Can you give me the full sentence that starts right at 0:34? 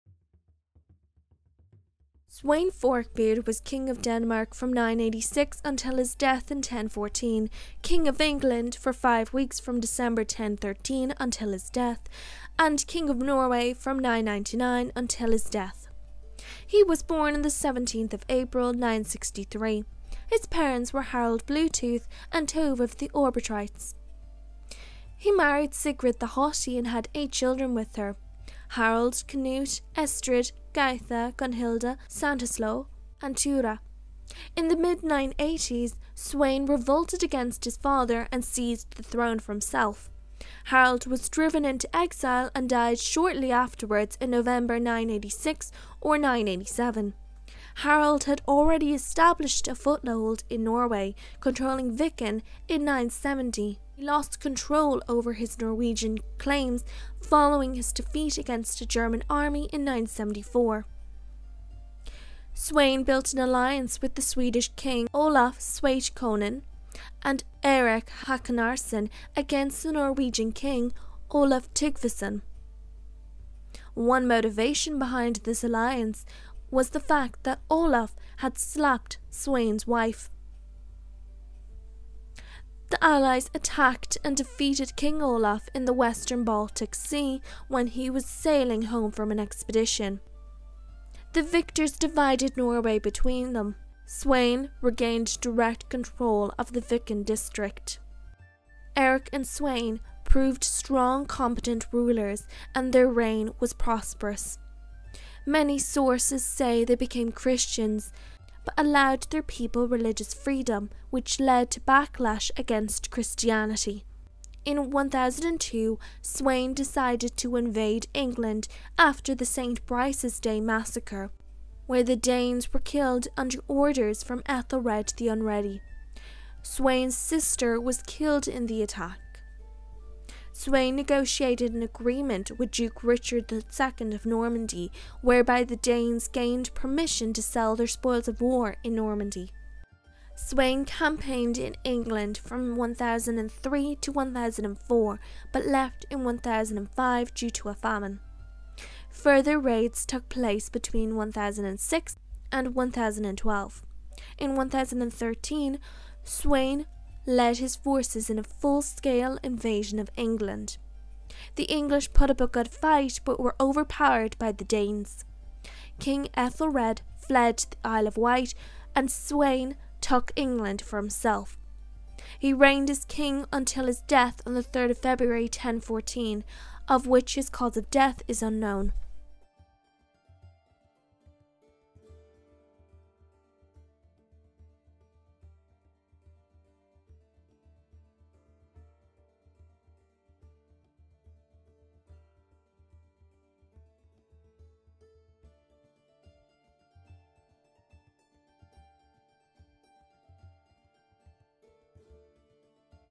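In the mid 980s, Sweyn revolted against his father and seized the throne for himself.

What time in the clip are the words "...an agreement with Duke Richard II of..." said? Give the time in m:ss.
2:11.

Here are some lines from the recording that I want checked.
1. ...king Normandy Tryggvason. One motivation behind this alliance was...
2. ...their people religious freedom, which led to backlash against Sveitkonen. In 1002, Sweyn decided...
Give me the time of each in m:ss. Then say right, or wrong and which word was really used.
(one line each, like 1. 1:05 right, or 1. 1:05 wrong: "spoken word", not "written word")
1. 1:10 wrong: "Olaf", not "Normandy"
2. 1:49 wrong: "Christianity", not "Sveitkonen".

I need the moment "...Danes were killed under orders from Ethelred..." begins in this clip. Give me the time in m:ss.
2:02.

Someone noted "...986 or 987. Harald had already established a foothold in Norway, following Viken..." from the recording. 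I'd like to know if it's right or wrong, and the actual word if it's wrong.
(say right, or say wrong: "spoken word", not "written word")
wrong: "controlling", not "following".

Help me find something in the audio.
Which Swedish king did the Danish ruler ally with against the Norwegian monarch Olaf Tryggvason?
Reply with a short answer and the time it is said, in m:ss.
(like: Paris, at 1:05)
Olaf Sveitkonen, at 1:05.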